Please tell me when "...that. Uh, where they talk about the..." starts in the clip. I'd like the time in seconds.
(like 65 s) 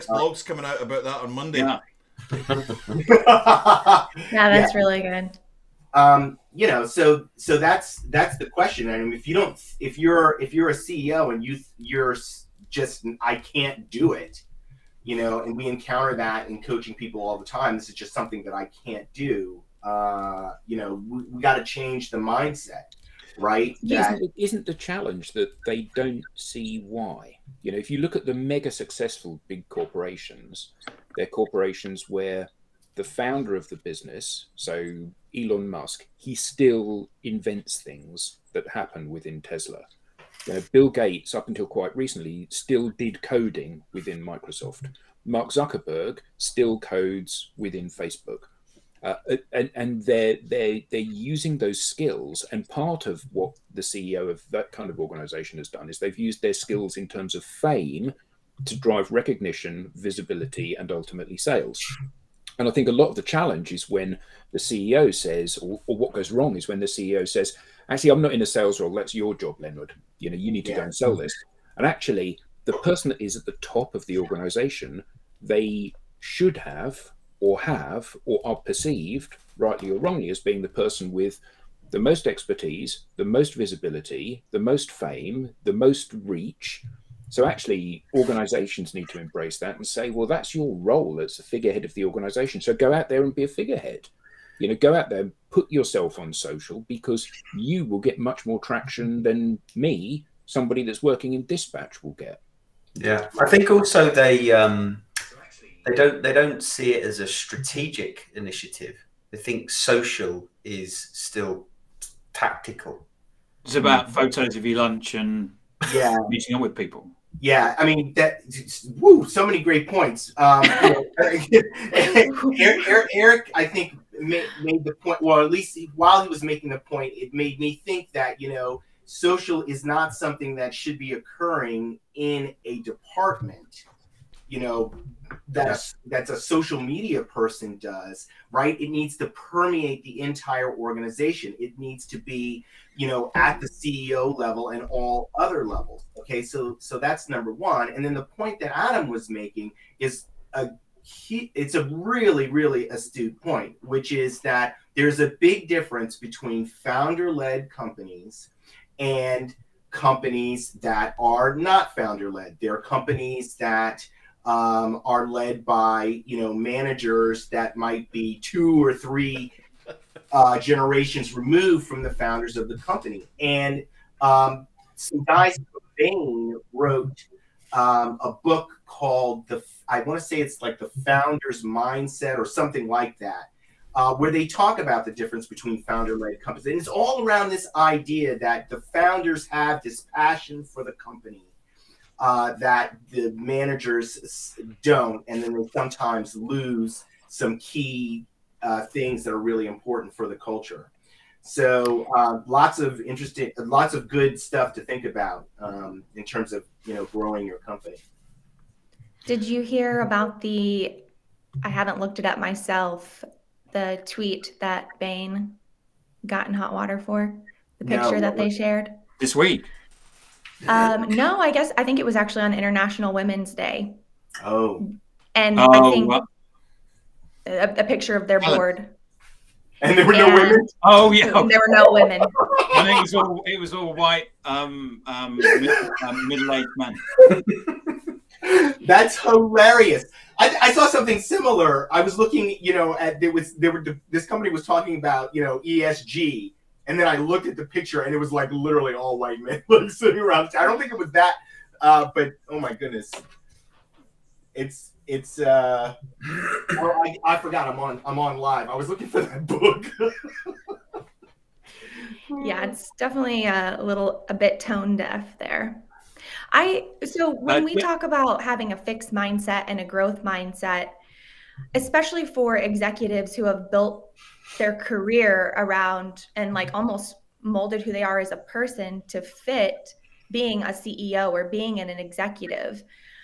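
183 s.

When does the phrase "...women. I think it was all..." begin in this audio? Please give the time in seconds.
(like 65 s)
231 s.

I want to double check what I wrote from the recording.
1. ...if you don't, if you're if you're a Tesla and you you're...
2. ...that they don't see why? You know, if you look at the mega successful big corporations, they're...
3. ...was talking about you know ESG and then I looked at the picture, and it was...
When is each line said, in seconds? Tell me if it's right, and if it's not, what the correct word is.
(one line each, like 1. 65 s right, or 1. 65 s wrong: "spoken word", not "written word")
1. 9 s wrong: "CEO", not "Tesla"
2. 25 s right
3. 244 s right.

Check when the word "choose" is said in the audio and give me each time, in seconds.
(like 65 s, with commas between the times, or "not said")
not said.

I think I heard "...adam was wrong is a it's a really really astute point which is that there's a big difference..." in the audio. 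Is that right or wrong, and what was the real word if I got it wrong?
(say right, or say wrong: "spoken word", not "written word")
wrong: "making", not "wrong".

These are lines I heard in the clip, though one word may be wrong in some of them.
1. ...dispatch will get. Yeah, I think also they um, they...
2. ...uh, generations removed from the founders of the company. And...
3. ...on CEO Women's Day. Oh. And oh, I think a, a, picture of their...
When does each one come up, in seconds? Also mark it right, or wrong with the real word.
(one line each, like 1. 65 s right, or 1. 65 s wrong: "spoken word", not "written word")
1. 101 s right
2. 170 s right
3. 222 s wrong: "International", not "CEO".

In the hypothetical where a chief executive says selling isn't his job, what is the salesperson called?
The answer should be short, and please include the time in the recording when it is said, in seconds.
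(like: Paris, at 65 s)
Leonard, at 69 s.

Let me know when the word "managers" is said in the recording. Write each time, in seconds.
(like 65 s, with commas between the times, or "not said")
166 s, 193 s.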